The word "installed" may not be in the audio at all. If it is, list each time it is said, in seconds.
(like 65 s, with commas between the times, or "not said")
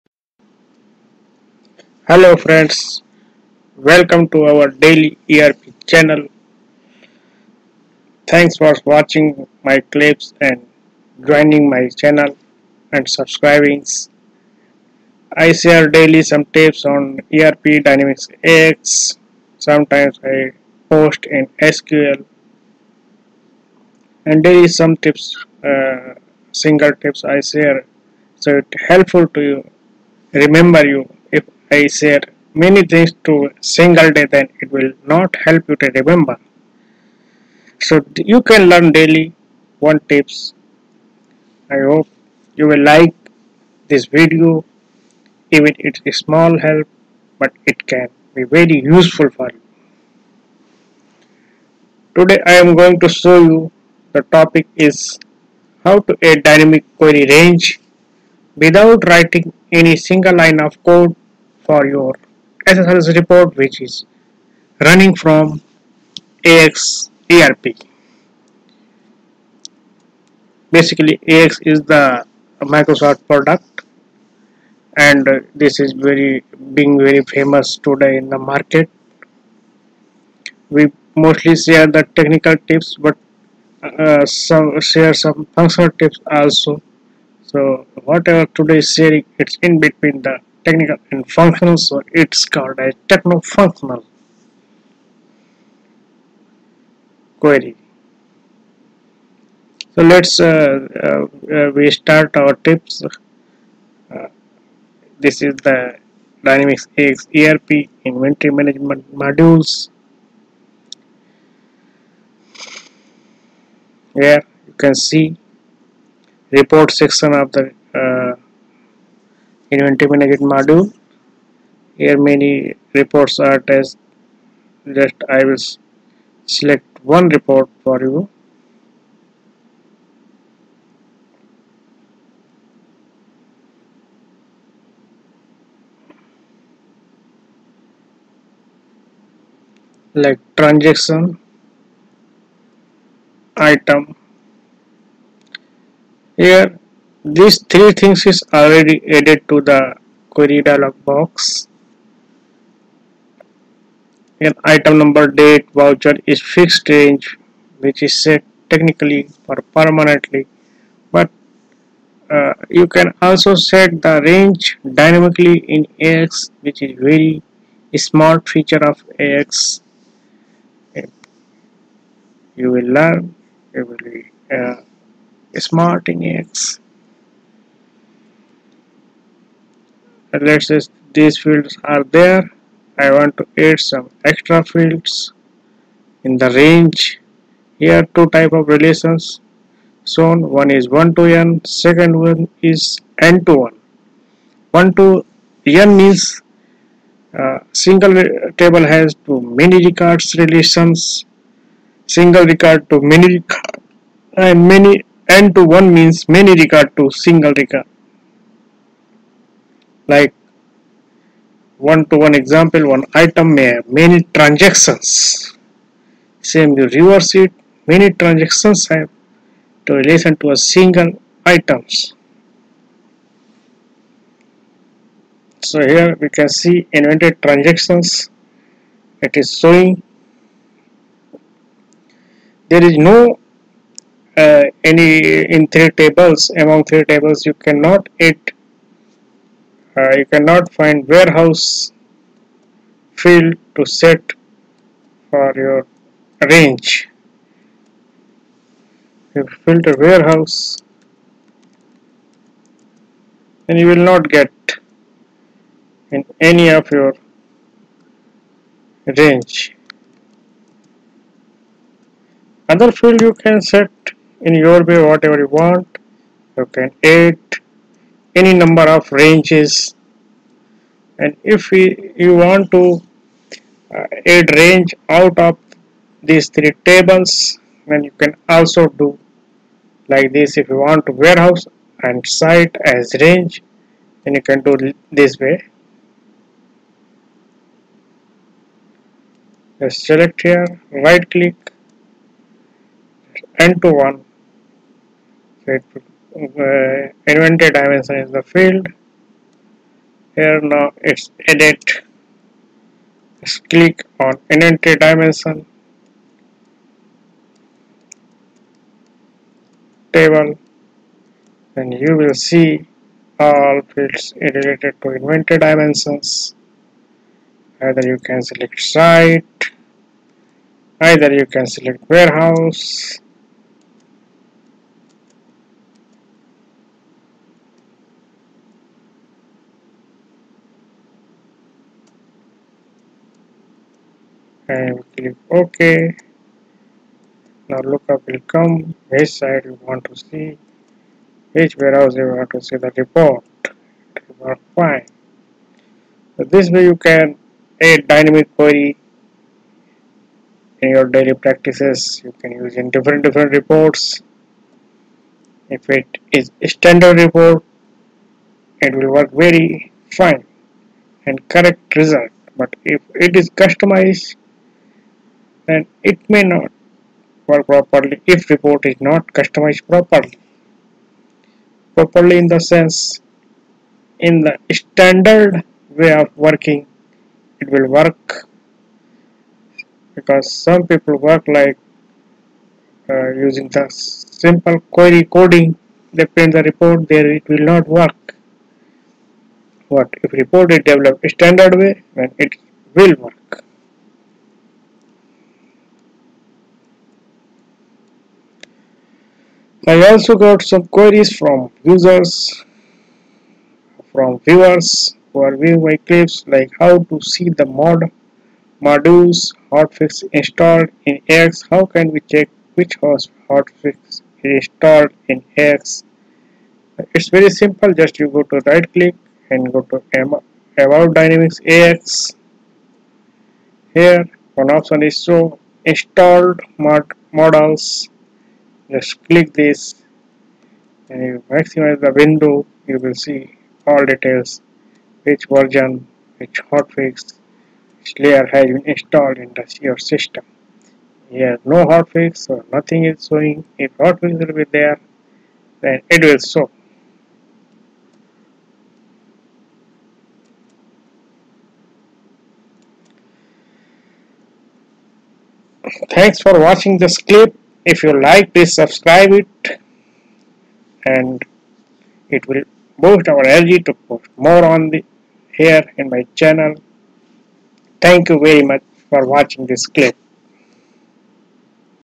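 410 s, 414 s, 425 s, 438 s.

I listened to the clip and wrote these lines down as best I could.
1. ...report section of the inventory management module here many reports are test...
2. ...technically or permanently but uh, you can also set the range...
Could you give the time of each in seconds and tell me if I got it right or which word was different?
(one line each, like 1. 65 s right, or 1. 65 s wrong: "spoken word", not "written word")
1. 116 s right
2. 158 s right.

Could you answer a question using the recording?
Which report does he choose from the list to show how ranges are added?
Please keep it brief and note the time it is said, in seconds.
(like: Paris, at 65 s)
transaction item, at 140 s.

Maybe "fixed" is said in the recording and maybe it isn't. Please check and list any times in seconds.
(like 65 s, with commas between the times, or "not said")
156 s.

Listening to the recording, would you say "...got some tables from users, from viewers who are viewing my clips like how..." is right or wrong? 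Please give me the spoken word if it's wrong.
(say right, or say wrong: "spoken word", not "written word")
wrong: "queries", not "tables".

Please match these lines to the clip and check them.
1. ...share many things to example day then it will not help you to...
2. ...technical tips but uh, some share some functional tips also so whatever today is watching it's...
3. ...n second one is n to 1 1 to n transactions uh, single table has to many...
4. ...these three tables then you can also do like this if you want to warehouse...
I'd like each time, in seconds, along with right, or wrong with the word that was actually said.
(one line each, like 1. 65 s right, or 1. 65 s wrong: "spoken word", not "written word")
1. 31 s wrong: "single", not "example"
2. 82 s wrong: "sharing", not "watching"
3. 191 s wrong: "means", not "transactions"
4. 276 s right.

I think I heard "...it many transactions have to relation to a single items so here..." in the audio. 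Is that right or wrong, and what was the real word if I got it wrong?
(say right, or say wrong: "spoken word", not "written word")
right.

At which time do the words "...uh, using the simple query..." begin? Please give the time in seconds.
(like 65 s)
383 s.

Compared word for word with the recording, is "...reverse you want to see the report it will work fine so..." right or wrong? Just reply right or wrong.
wrong.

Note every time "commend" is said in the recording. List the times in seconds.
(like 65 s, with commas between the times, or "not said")
not said.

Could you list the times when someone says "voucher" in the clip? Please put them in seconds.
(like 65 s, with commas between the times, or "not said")
155 s.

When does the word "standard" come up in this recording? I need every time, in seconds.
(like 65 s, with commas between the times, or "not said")
356 s, 374 s, 391 s.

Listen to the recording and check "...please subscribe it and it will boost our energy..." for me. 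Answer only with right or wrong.
right.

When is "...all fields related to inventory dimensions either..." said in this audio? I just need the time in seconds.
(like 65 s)
313 s.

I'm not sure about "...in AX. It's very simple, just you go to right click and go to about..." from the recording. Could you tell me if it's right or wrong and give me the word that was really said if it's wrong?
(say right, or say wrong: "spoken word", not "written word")
right.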